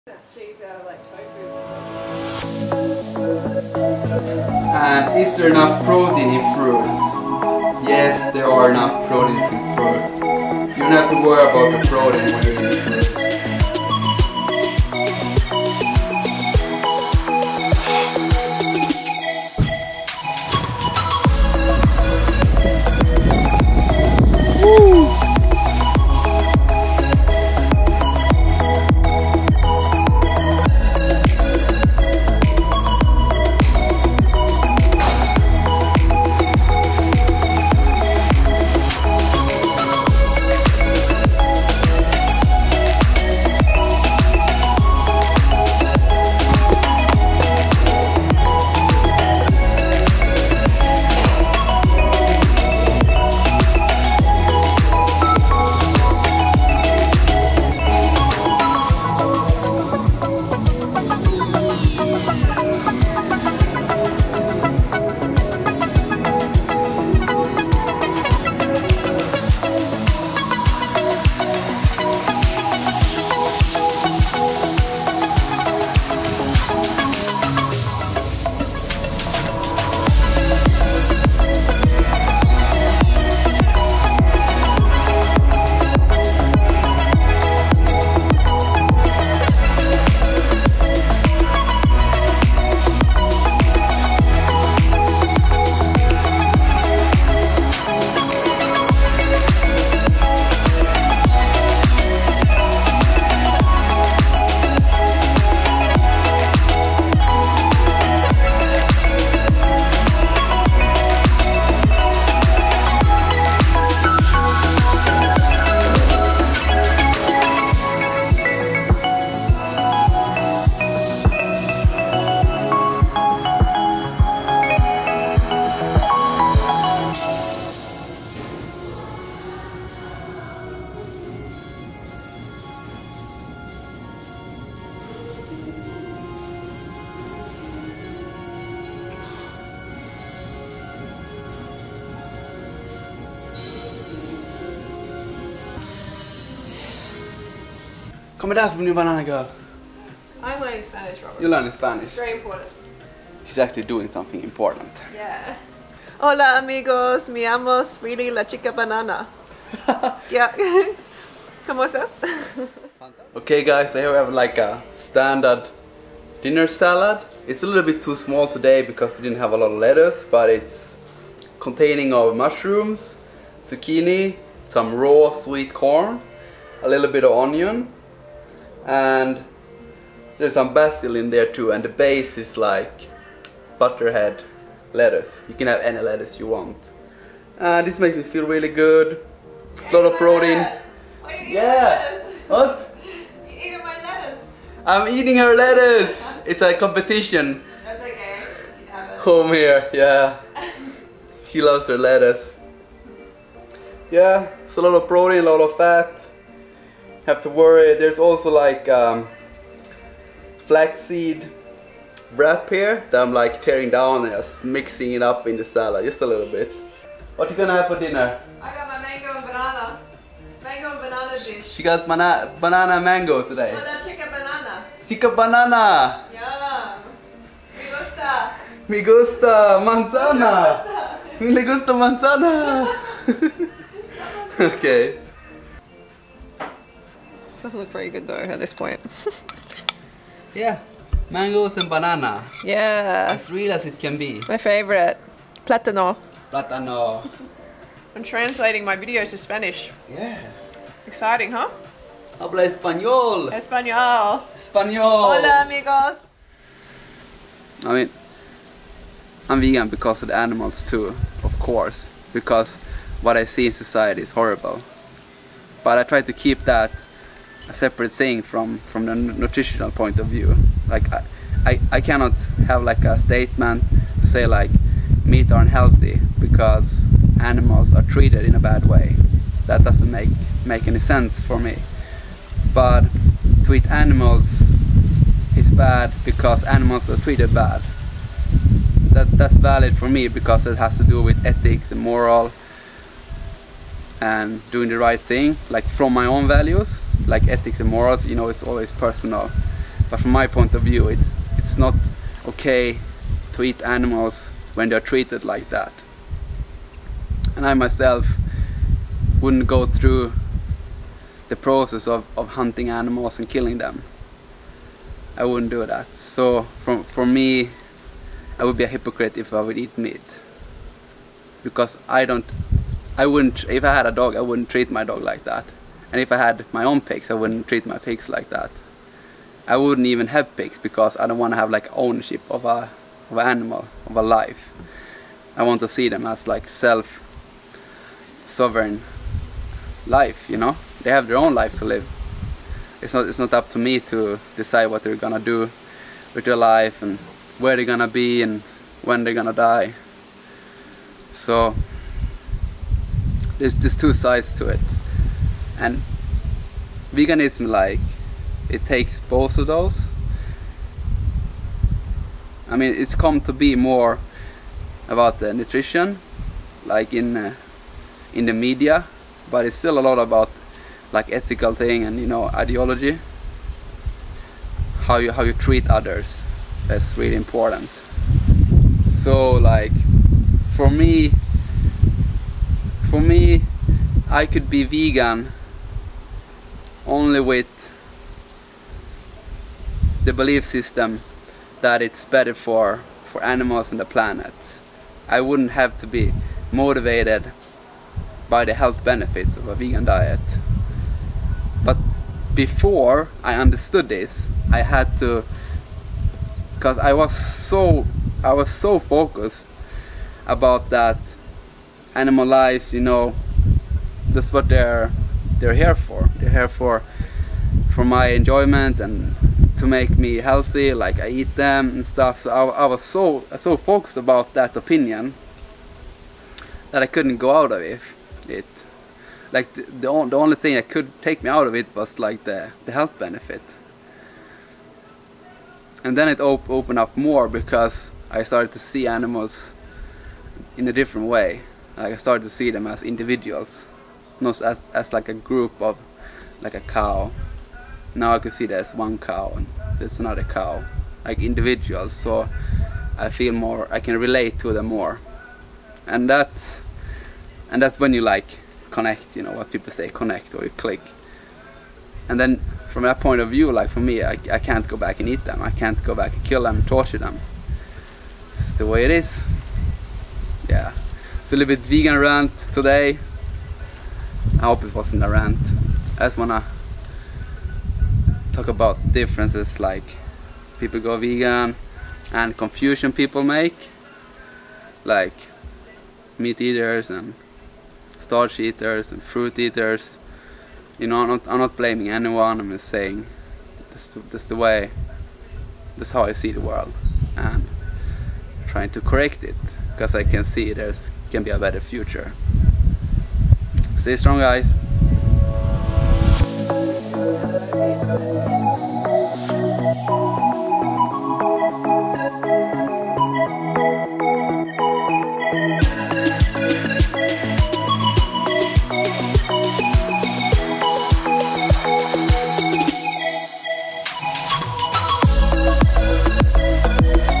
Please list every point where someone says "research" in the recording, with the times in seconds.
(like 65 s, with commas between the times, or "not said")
not said.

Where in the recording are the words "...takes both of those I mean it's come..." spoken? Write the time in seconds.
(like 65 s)
358 s.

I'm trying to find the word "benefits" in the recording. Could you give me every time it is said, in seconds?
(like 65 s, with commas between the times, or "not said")
399 s, 433 s.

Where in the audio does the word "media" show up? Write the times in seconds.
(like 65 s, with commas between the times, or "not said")
368 s.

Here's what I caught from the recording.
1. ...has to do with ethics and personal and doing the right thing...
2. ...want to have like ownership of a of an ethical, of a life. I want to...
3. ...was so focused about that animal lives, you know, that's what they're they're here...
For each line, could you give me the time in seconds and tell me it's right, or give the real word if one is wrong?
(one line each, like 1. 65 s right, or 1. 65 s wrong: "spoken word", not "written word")
1. 290 s wrong: "moral", not "personal"
2. 331 s wrong: "animal", not "ethical"
3. 408 s right.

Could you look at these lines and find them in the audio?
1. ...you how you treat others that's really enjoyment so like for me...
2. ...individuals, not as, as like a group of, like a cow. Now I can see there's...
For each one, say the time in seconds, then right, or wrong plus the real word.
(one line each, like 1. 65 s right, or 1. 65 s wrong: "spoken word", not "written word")
1. 375 s wrong: "important", not "enjoyment"
2. 443 s right.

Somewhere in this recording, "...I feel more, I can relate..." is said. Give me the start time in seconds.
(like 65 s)
453 s.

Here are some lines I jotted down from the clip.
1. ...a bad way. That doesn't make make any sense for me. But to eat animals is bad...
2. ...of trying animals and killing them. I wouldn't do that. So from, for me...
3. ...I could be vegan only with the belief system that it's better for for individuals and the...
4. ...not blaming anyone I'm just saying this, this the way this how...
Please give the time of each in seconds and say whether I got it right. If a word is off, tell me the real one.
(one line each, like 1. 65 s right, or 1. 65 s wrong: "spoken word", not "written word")
1. 278 s right
2. 312 s wrong: "hunting", not "trying"
3. 384 s wrong: "animals", not "individuals"
4. 491 s right.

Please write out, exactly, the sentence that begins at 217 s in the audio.
What you gonna have for dinner?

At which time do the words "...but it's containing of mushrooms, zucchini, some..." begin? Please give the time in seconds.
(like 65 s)
170 s.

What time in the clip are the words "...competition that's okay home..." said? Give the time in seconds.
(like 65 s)
196 s.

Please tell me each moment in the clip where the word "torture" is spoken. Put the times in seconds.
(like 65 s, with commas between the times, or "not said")
466 s.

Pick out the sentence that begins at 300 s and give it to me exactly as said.
But from my point of view, it's it's not okay to eat animals when they're treated like that.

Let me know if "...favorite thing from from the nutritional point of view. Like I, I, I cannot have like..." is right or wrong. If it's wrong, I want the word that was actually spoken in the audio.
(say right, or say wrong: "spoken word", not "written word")
wrong: "separate", not "favorite".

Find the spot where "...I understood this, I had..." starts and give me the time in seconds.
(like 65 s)
403 s.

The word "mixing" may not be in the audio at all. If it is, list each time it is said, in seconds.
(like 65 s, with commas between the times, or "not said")
214 s.